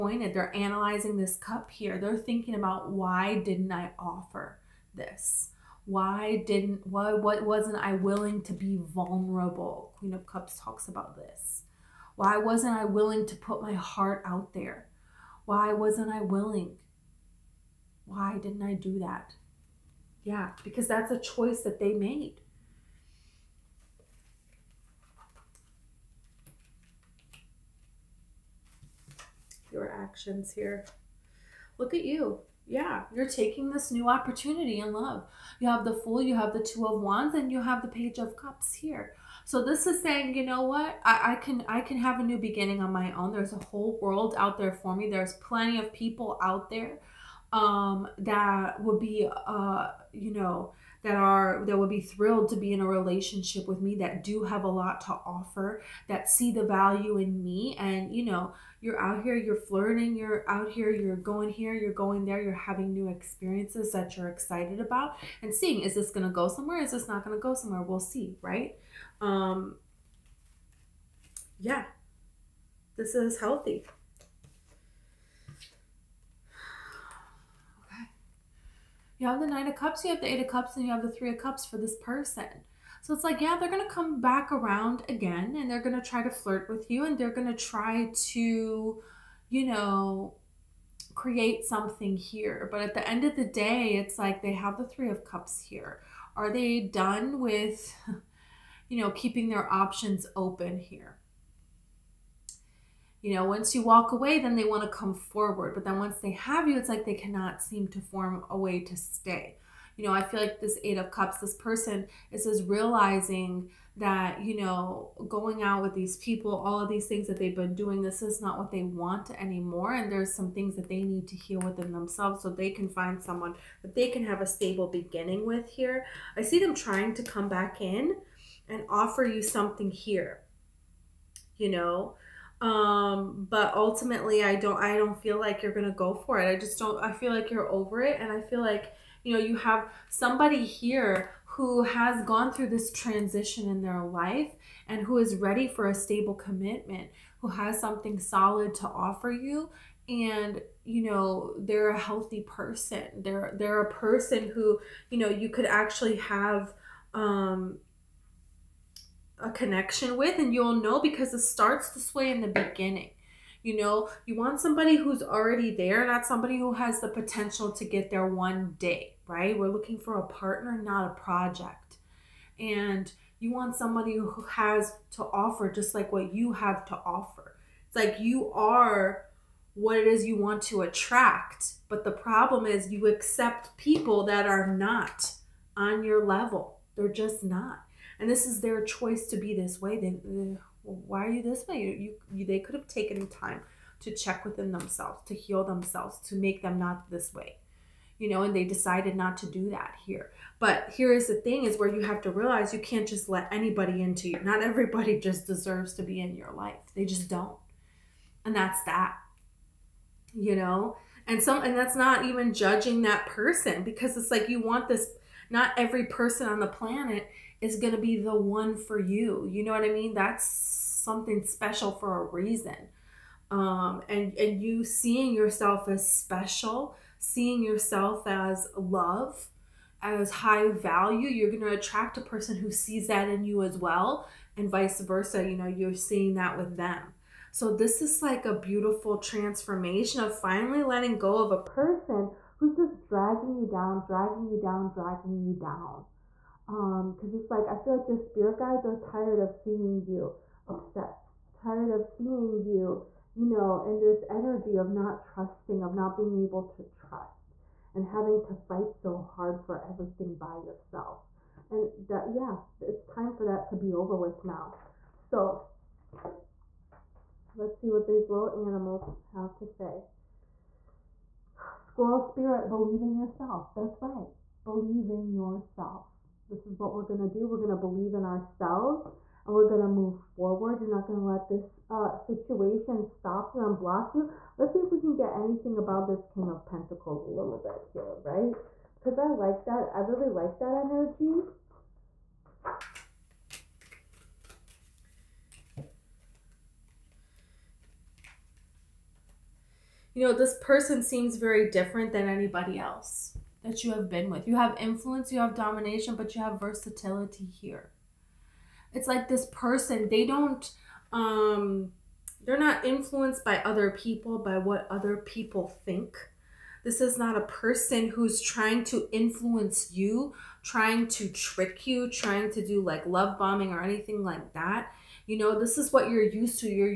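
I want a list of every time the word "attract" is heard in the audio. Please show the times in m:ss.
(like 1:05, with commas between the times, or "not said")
3:00, 3:51.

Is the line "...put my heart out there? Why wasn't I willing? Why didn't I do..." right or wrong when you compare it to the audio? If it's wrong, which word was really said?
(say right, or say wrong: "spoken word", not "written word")
right.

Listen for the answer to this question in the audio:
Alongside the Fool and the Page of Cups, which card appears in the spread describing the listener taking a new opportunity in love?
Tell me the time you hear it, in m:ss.
0:36.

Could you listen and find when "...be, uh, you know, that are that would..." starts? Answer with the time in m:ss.
0:48.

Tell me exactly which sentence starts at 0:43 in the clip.
There's a whole world out there for me.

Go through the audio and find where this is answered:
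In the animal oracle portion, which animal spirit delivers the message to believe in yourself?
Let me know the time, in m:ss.
4:31.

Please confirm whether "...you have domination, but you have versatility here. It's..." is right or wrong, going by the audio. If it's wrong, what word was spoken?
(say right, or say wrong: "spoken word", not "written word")
right.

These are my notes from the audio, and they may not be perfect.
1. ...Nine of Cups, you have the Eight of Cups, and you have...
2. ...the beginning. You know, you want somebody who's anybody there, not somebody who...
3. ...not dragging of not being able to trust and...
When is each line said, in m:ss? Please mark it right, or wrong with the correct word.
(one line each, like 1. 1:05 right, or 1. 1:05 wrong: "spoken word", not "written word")
1. 1:19 right
2. 2:42 wrong: "already", not "anybody"
3. 4:14 wrong: "trusting", not "dragging".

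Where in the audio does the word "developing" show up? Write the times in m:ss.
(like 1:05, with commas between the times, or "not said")
not said.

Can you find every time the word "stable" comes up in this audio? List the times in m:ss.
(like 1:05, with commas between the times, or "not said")
2:04, 2:25.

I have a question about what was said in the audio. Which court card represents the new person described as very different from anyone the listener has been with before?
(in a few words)
King of Pentacles.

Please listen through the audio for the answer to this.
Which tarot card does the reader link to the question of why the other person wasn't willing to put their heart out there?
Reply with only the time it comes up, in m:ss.
0:09.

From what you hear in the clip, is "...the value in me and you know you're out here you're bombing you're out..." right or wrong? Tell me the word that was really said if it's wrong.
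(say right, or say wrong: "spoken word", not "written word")
wrong: "flirting", not "bombing".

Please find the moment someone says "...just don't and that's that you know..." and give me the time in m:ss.
3:27.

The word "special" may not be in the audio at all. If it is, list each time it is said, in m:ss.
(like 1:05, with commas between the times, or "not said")
3:41, 3:46.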